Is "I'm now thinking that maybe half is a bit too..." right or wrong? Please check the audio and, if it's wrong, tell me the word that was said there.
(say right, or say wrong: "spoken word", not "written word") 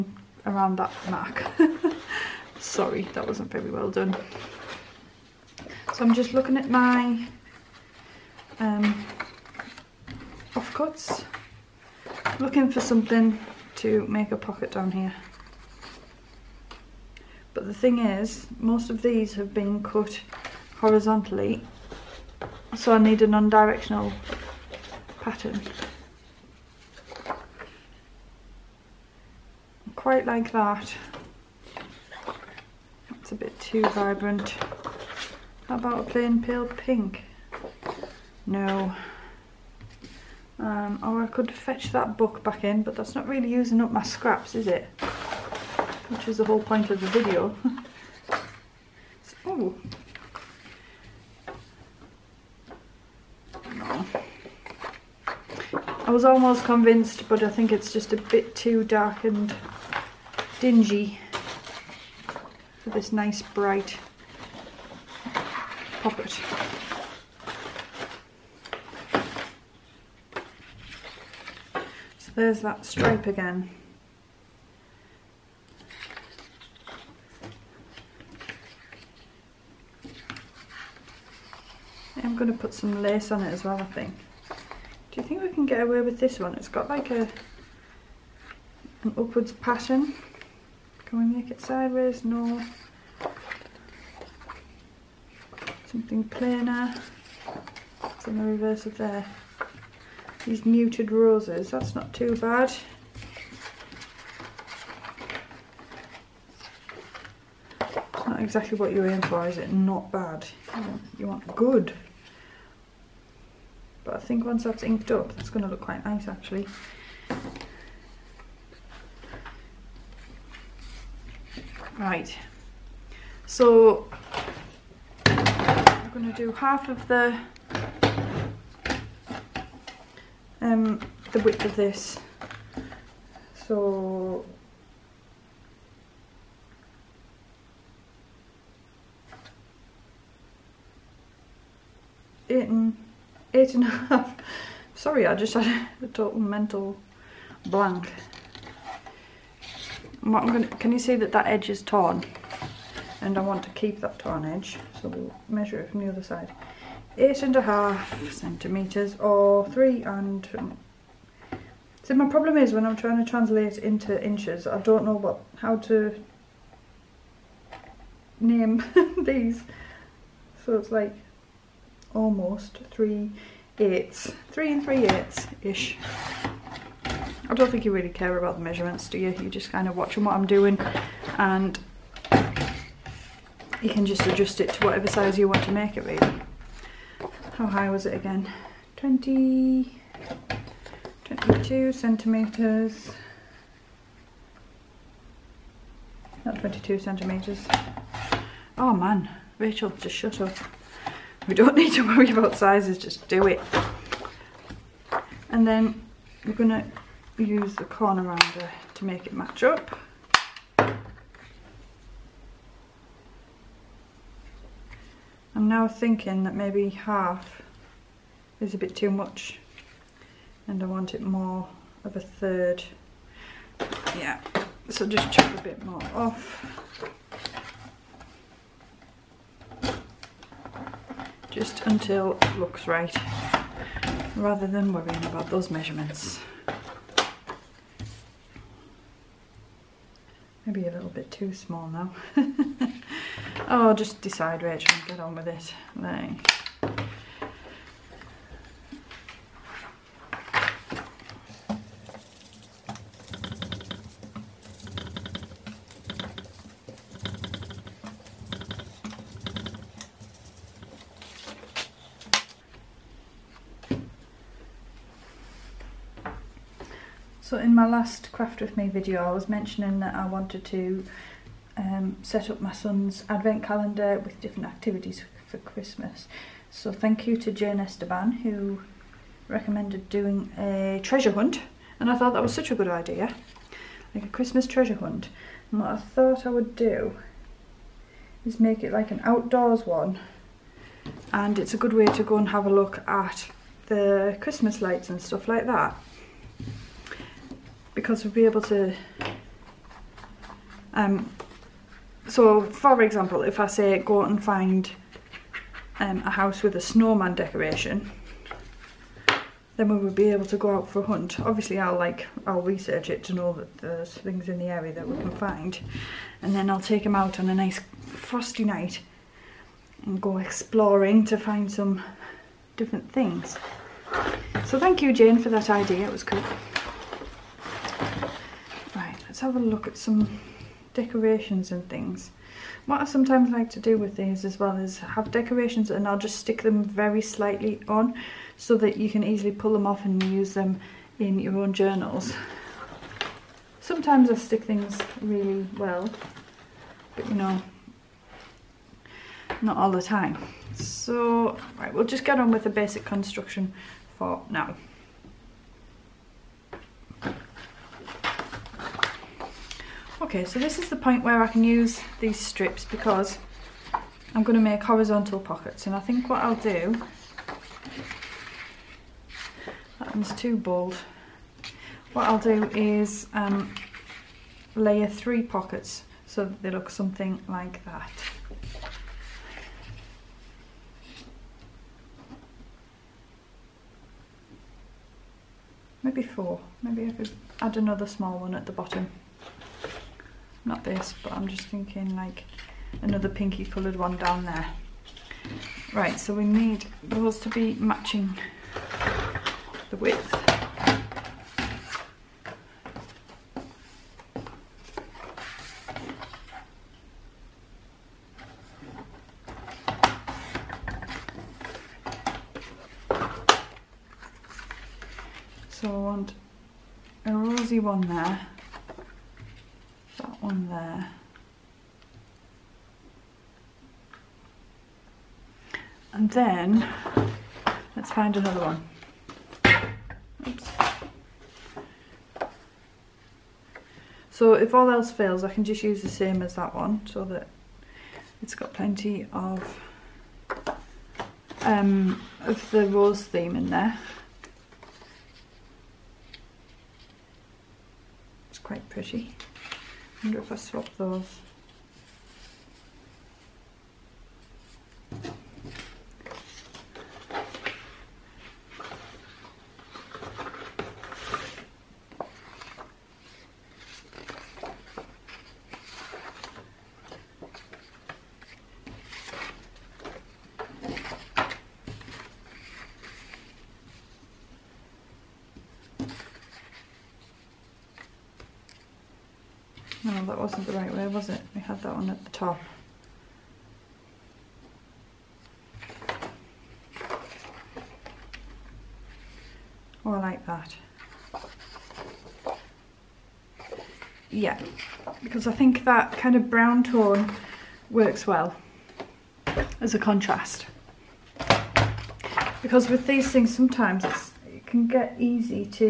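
right.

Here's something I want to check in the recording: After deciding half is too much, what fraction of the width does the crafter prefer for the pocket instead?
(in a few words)
a third.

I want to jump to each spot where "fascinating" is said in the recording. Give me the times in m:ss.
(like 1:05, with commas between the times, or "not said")
not said.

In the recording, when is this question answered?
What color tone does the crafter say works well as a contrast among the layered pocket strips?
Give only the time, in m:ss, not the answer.
8:16.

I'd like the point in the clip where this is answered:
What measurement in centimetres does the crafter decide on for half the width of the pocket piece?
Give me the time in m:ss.
2:37.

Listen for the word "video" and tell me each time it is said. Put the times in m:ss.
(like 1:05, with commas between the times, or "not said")
0:47, 4:28.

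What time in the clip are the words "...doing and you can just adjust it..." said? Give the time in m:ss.
3:00.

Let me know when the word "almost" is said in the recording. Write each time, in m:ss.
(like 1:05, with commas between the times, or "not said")
0:56, 2:52.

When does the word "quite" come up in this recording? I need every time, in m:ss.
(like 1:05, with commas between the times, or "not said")
0:29, 1:55, 7:28.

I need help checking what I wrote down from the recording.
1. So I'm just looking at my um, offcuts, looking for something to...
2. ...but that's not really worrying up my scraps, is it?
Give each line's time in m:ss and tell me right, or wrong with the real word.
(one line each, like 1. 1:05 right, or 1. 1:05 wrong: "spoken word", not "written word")
1. 0:05 right
2. 0:42 wrong: "using", not "worrying".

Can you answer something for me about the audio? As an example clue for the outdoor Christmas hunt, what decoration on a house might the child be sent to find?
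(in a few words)
snowman.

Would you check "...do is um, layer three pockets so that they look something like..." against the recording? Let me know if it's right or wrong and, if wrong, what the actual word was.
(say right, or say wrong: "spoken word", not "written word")
right.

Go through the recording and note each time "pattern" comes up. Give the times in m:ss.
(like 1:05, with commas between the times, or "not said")
0:25, 1:29.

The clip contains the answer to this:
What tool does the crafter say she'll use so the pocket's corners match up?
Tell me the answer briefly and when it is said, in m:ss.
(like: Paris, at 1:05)
corner rounder, at 3:27.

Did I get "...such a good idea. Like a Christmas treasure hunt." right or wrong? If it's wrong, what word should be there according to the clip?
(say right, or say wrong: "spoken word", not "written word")
right.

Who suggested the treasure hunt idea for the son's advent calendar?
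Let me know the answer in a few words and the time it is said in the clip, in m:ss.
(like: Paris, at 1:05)
Jane Esteban, at 4:37.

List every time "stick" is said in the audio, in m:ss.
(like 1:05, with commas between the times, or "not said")
5:36, 5:44.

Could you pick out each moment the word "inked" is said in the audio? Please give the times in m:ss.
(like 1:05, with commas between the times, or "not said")
1:54.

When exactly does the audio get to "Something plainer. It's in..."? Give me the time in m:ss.
1:35.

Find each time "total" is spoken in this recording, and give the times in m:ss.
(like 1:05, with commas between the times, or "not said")
2:26.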